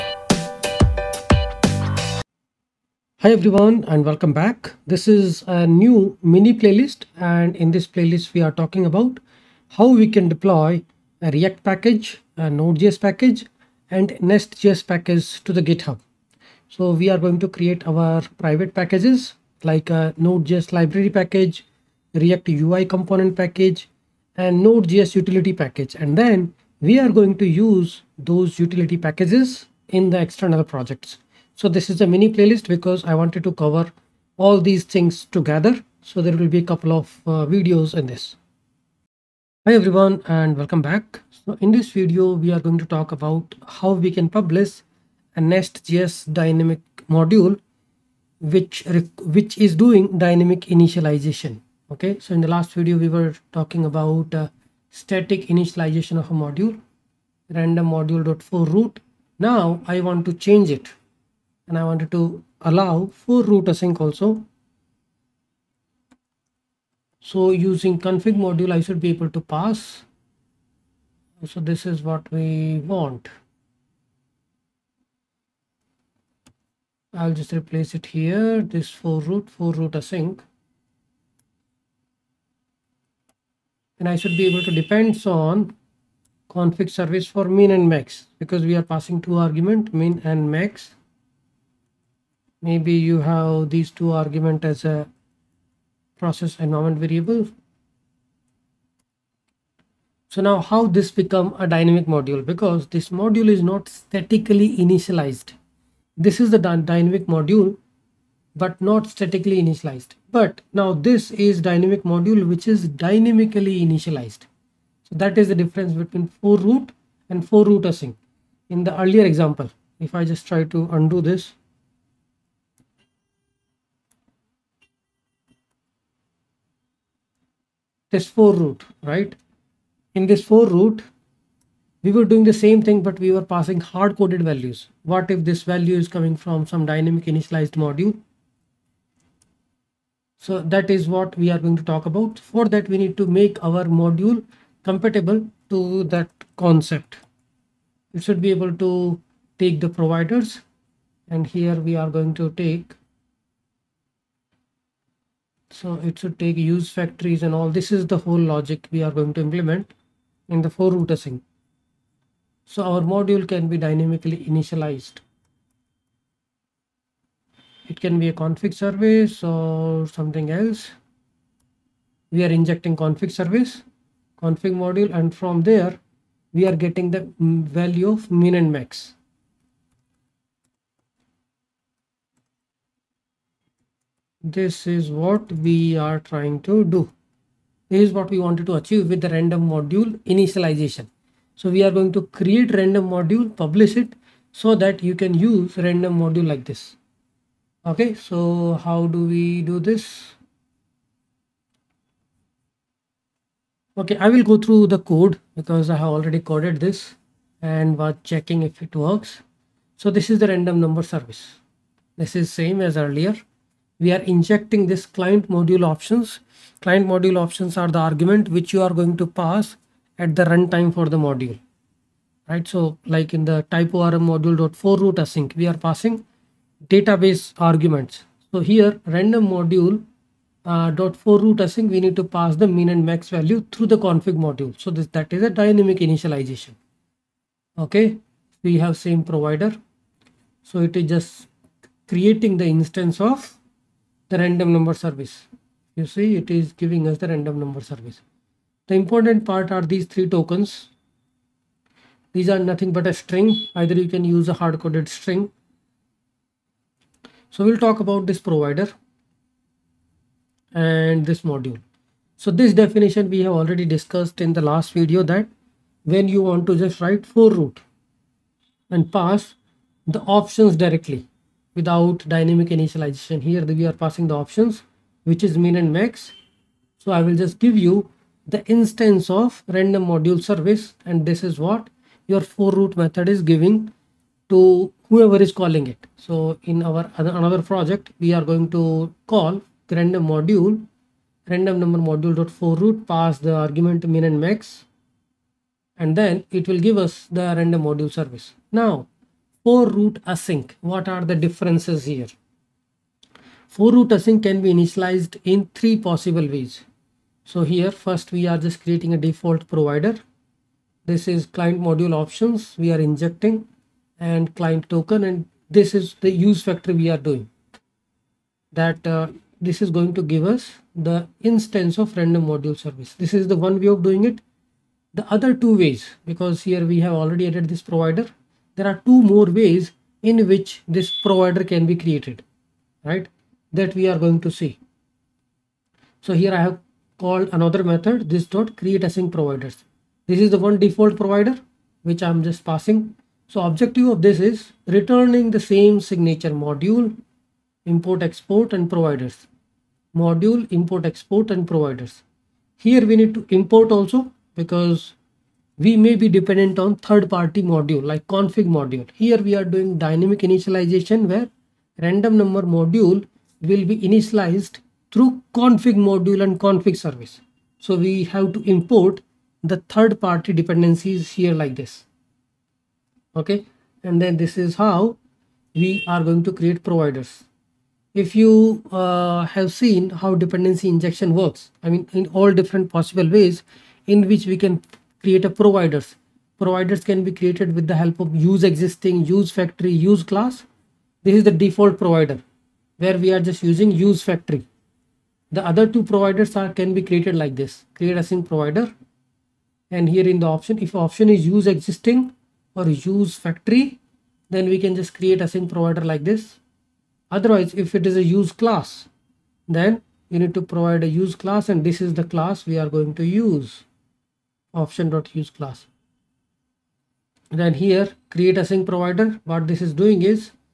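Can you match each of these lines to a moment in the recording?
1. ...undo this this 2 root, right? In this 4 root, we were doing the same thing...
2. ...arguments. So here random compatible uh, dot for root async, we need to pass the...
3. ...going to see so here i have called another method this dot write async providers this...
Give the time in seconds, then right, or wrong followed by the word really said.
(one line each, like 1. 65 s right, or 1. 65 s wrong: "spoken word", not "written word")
1. 120 s wrong: "4", not "2"
2. 227 s wrong: "module", not "compatible"
3. 334 s wrong: "create", not "write".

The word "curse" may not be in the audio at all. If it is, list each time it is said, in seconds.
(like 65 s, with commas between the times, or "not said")
not said.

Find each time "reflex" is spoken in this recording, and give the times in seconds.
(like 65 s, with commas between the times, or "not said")
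not said.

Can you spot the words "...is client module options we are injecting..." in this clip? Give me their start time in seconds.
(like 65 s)
311 s.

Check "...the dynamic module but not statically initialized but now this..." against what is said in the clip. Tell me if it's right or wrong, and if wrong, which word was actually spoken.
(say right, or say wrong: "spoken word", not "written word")
right.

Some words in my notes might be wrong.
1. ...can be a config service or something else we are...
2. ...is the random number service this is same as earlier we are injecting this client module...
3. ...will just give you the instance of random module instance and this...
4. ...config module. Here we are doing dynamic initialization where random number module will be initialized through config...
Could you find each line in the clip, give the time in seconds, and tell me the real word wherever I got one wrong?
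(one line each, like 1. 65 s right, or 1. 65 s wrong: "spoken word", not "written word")
1. 168 s right
2. 210 s right
3. 277 s wrong: "service", not "instance"
4. 358 s right.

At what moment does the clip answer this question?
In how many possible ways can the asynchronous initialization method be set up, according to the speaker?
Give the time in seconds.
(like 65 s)
305 s.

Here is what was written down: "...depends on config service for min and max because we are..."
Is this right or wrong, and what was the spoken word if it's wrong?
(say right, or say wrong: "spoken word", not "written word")
right.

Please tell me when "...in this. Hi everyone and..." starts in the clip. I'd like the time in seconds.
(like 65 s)
37 s.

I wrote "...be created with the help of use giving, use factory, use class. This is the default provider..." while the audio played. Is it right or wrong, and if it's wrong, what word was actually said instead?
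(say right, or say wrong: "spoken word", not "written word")
wrong: "existing", not "giving".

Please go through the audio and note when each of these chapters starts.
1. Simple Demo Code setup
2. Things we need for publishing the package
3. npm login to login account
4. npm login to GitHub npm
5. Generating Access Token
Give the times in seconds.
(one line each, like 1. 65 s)
1. 266 s
2. 116 s
3. 206 s
4. 326 s
5. 296 s.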